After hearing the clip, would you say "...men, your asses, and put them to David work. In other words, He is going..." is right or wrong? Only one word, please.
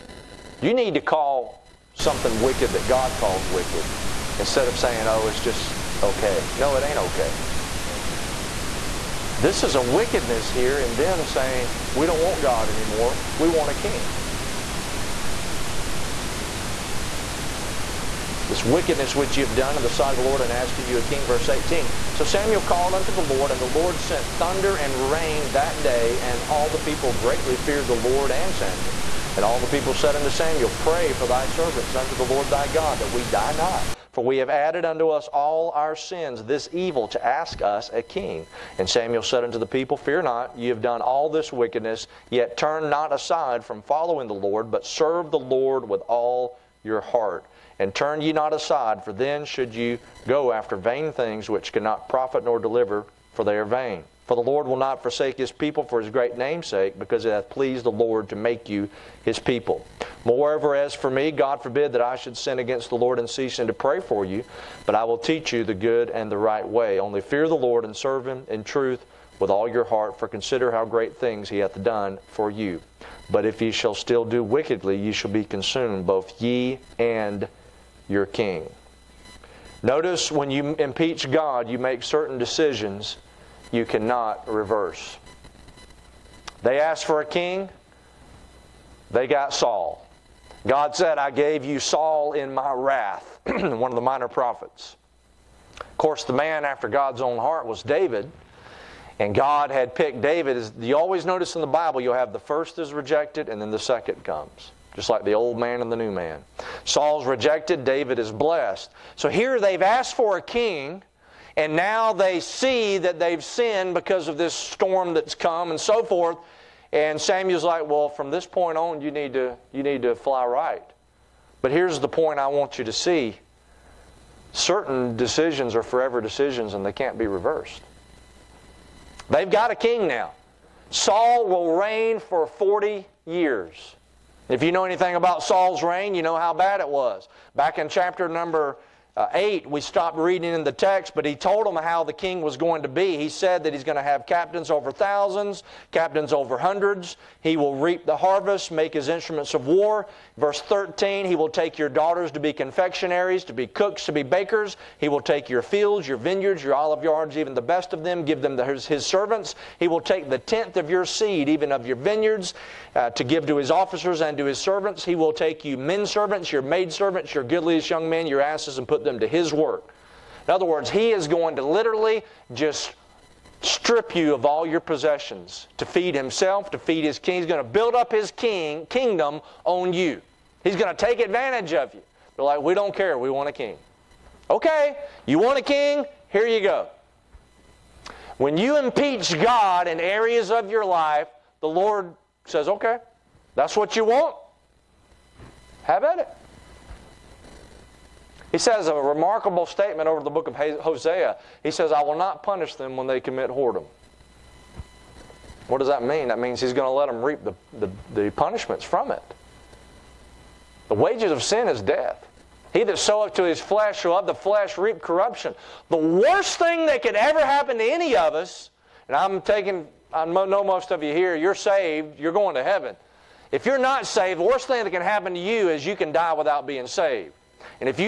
wrong.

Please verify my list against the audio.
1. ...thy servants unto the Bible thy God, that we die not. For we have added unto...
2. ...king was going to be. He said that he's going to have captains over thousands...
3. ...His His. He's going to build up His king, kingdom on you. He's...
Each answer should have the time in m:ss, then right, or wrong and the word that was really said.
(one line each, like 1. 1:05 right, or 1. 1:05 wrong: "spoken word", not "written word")
1. 0:31 wrong: "Lord", not "Bible"
2. 2:22 right
3. 2:57 wrong: "King", not "His".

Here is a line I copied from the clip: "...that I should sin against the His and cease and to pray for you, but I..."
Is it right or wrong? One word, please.
wrong.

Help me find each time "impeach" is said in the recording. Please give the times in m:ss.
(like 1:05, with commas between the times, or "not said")
1:20, 3:08.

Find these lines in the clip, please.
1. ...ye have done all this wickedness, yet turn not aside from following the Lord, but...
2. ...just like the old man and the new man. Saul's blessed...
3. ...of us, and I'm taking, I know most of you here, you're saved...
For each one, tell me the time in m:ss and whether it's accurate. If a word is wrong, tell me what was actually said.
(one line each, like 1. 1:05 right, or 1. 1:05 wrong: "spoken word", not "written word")
1. 0:40 right
2. 1:44 wrong: "rejected", not "blessed"
3. 3:38 right.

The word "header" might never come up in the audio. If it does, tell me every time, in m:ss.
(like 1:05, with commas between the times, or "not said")
not said.